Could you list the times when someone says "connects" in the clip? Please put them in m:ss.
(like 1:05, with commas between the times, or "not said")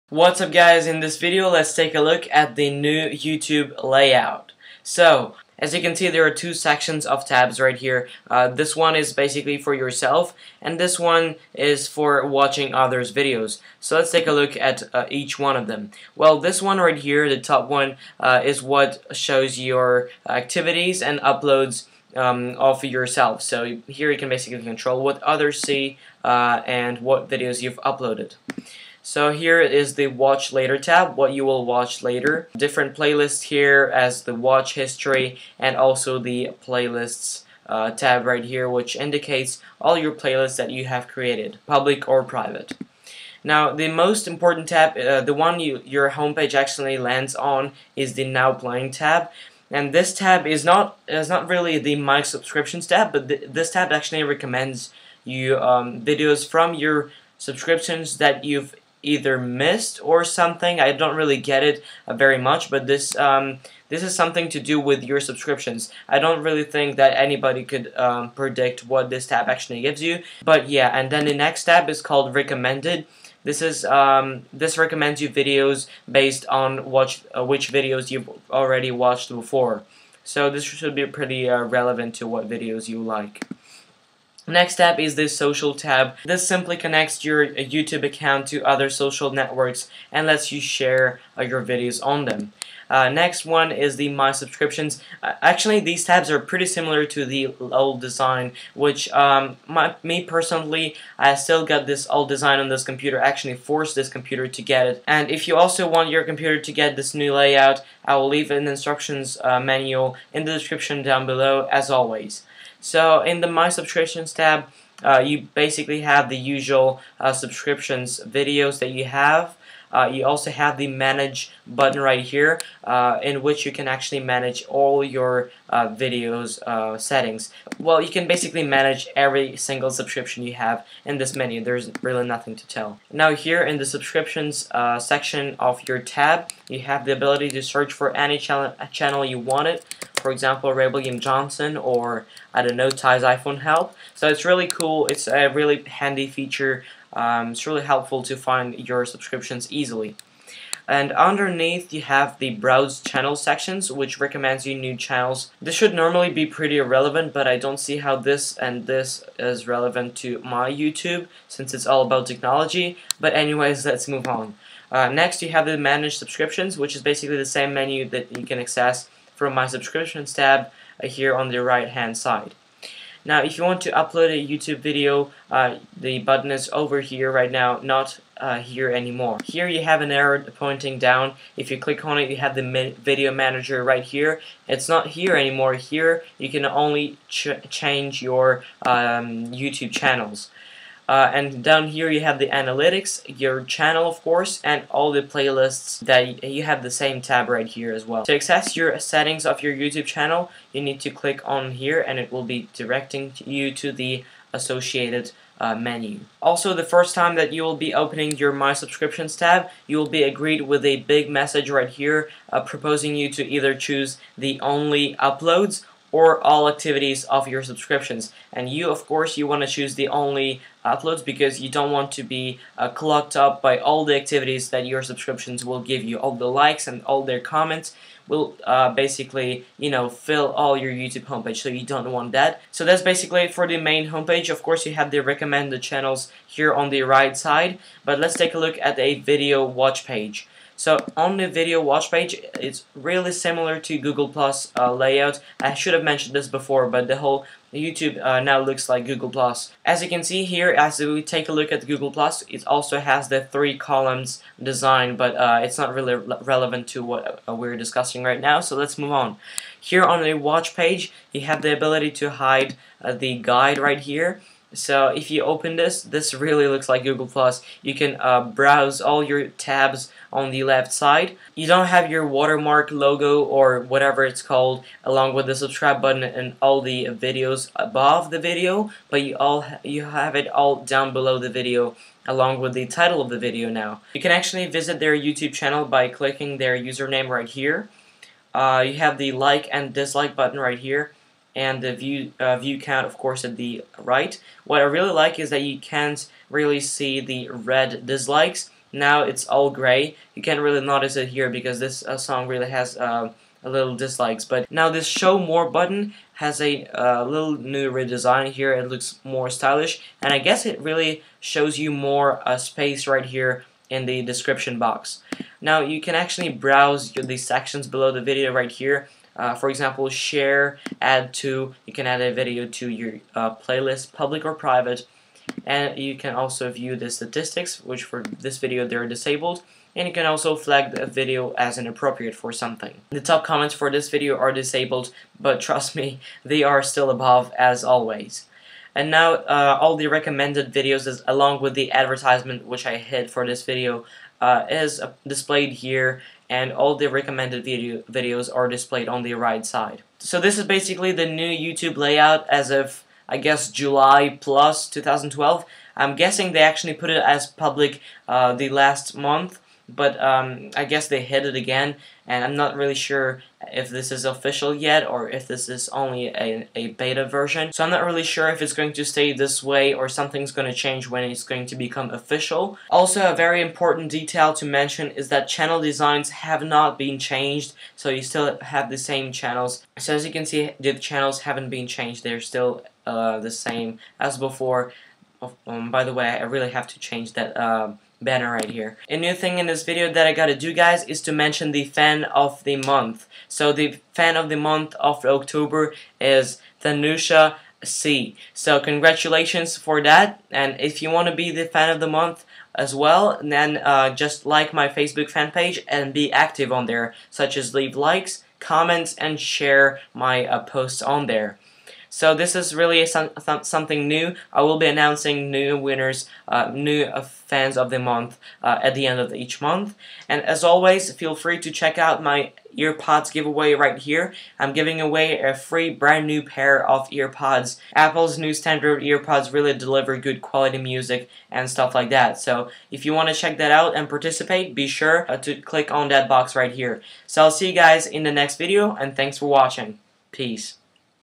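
1:26.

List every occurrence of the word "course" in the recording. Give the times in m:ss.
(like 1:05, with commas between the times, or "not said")
3:14, 3:39, 3:54, 4:53.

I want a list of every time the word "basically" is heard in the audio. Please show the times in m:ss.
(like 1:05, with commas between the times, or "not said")
0:09, 0:24, 1:55, 2:08, 2:47, 3:48, 3:53, 5:50.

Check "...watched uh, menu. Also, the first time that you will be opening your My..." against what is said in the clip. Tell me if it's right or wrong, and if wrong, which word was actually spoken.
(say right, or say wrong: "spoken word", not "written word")
wrong: "associated", not "watched".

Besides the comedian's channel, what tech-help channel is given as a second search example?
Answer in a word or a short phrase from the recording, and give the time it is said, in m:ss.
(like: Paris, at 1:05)
Ty's iPhone Help, at 2:22.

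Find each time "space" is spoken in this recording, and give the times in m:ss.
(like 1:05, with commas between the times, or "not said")
5:12.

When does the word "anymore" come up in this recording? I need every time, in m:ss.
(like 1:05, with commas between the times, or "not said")
2:58, 3:05.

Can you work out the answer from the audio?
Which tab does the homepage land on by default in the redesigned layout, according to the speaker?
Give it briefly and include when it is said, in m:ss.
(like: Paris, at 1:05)
Now Playing, at 0:48.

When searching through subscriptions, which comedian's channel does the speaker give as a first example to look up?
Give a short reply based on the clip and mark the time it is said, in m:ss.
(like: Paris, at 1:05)
Ray William Johnson, at 2:20.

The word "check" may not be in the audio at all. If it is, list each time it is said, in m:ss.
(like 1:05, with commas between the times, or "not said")
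7:01, 7:13.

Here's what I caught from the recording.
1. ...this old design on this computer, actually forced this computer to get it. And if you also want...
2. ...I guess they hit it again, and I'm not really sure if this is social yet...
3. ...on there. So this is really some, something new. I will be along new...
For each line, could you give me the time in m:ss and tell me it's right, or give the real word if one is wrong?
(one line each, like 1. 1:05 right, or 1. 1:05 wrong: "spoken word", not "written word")
1. 1:41 right
2. 6:00 wrong: "official", not "social"
3. 6:51 wrong: "announcing", not "along".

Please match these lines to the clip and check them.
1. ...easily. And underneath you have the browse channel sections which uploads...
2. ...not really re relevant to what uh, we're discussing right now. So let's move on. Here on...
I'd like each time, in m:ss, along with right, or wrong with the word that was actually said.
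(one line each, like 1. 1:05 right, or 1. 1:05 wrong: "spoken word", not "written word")
1. 2:29 wrong: "recommends", not "uploads"
2. 4:15 right.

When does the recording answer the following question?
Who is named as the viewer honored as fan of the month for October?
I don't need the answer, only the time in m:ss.
6:36.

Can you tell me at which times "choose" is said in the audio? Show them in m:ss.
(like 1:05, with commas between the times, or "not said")
3:33, 3:39.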